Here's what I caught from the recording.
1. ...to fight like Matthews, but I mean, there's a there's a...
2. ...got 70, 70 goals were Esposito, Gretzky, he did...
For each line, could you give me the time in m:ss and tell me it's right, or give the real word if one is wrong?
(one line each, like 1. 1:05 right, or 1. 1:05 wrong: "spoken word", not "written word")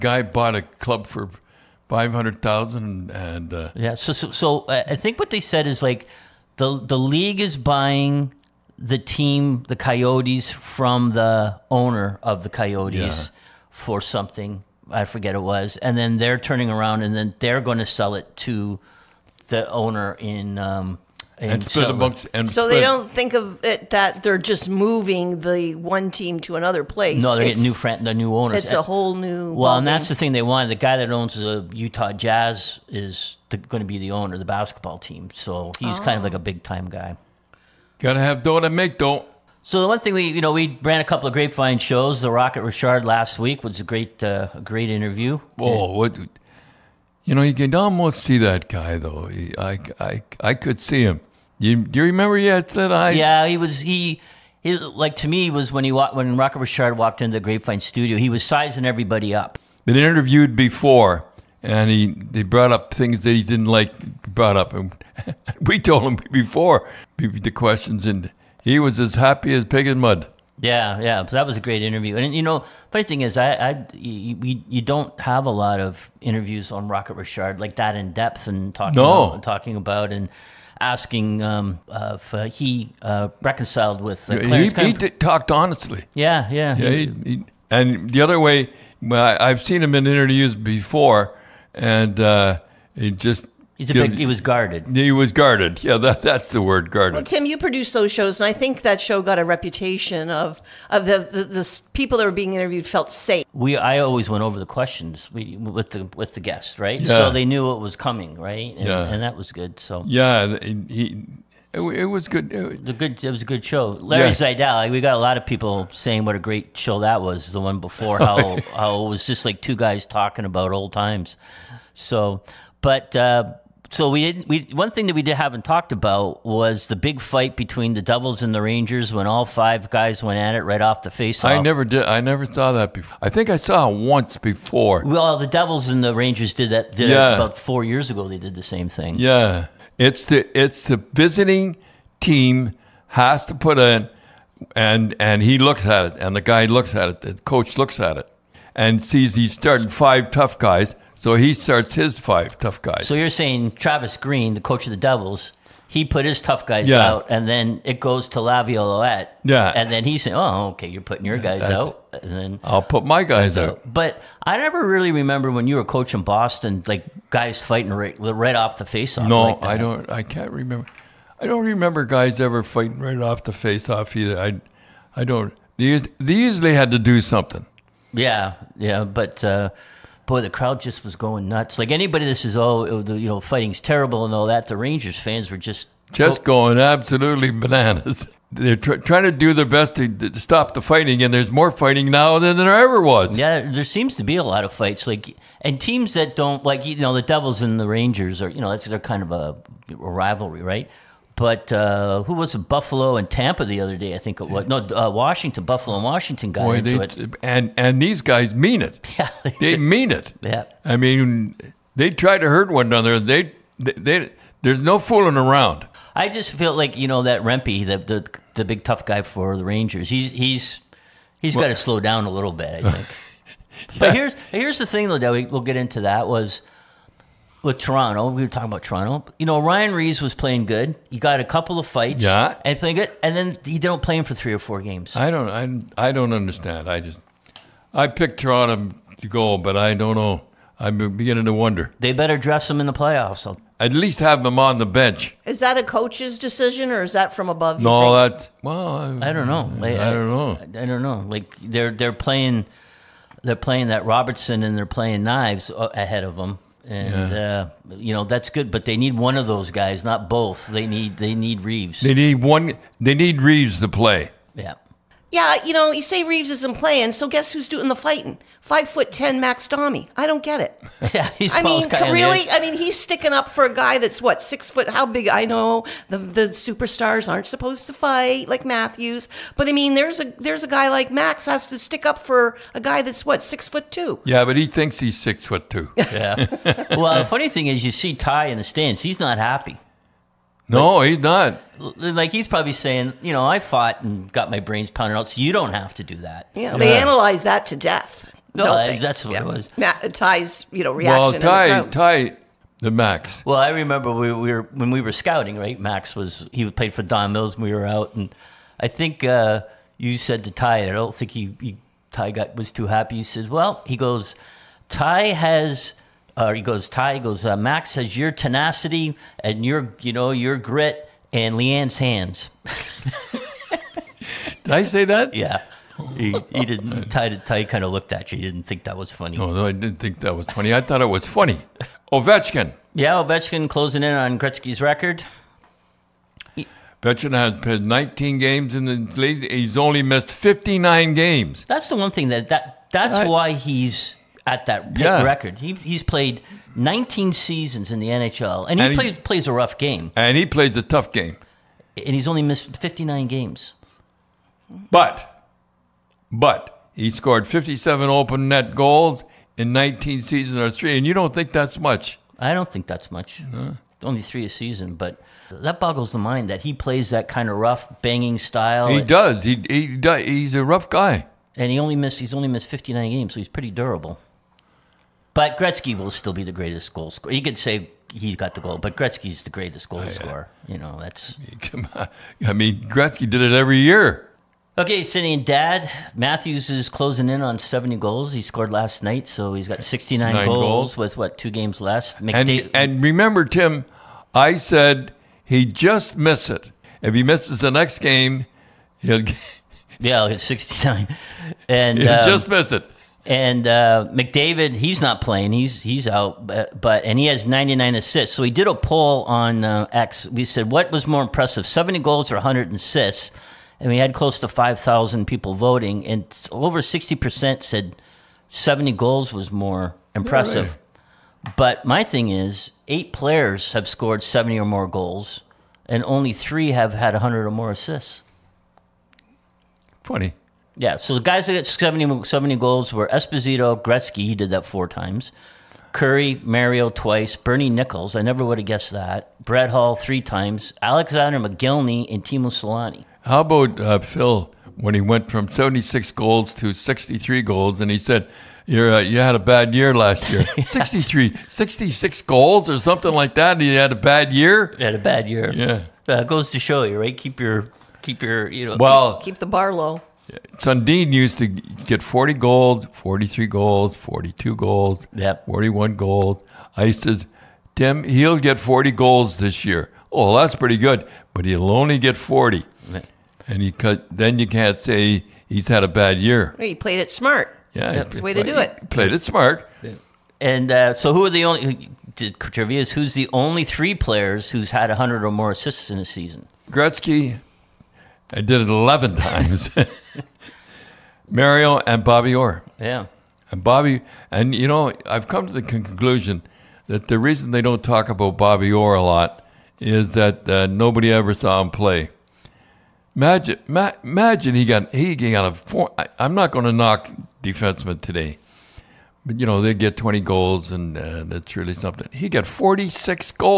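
1. 4:37 right
2. 7:11 right.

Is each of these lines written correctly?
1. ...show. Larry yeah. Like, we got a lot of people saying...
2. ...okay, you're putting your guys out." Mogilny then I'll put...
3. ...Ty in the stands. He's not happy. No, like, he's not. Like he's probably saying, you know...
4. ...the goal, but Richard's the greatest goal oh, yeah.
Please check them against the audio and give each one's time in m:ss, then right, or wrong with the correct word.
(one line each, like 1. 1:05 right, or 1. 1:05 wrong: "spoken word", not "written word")
1. 1:53 right
2. 2:40 wrong: "And", not "Mogilny"
3. 4:48 right
4. 6:18 wrong: "Gretzky", not "Richard".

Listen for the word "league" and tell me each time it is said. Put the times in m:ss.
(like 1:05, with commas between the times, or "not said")
0:06, 5:39.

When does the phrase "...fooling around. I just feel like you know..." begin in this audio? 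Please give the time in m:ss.
3:34.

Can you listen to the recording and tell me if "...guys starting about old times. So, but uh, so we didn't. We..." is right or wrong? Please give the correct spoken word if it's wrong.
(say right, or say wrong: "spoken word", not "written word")
wrong: "talking", not "starting".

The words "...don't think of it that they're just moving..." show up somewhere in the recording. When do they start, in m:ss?
0:22.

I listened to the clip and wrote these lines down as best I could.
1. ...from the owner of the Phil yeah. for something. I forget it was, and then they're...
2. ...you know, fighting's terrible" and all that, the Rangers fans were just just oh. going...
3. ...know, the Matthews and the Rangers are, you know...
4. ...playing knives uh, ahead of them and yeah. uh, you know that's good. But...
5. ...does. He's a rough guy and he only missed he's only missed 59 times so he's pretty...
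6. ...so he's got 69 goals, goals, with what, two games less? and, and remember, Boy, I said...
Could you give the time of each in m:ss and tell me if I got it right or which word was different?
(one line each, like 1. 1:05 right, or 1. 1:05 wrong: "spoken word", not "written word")
1. 0:10 wrong: "Coyotes", not "Phil"
2. 3:03 right
3. 3:16 wrong: "Devils", not "Matthews"
4. 4:14 right
5. 6:09 wrong: "games", not "times"
6. 6:29 wrong: "Tim", not "Boy".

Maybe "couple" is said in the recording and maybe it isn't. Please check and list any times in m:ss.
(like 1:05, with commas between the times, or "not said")
0:41, 3:51.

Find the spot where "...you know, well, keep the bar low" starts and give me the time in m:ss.
7:38.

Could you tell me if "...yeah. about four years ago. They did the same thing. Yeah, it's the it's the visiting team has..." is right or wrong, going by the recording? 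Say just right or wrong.
right.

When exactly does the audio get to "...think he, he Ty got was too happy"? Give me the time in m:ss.
5:11.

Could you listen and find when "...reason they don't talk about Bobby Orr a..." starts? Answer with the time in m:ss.
8:17.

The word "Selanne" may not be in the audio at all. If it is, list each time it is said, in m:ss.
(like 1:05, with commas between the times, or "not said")
7:22.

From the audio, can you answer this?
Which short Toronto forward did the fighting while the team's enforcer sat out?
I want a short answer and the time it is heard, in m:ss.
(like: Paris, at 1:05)
Max Domi, at 4:29.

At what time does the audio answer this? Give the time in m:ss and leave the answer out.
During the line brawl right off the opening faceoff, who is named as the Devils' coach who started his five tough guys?
2:33.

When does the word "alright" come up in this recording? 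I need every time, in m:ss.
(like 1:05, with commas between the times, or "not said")
not said.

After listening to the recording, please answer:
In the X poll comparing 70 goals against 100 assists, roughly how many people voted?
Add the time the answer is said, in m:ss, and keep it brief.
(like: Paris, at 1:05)
5,000, at 6:54.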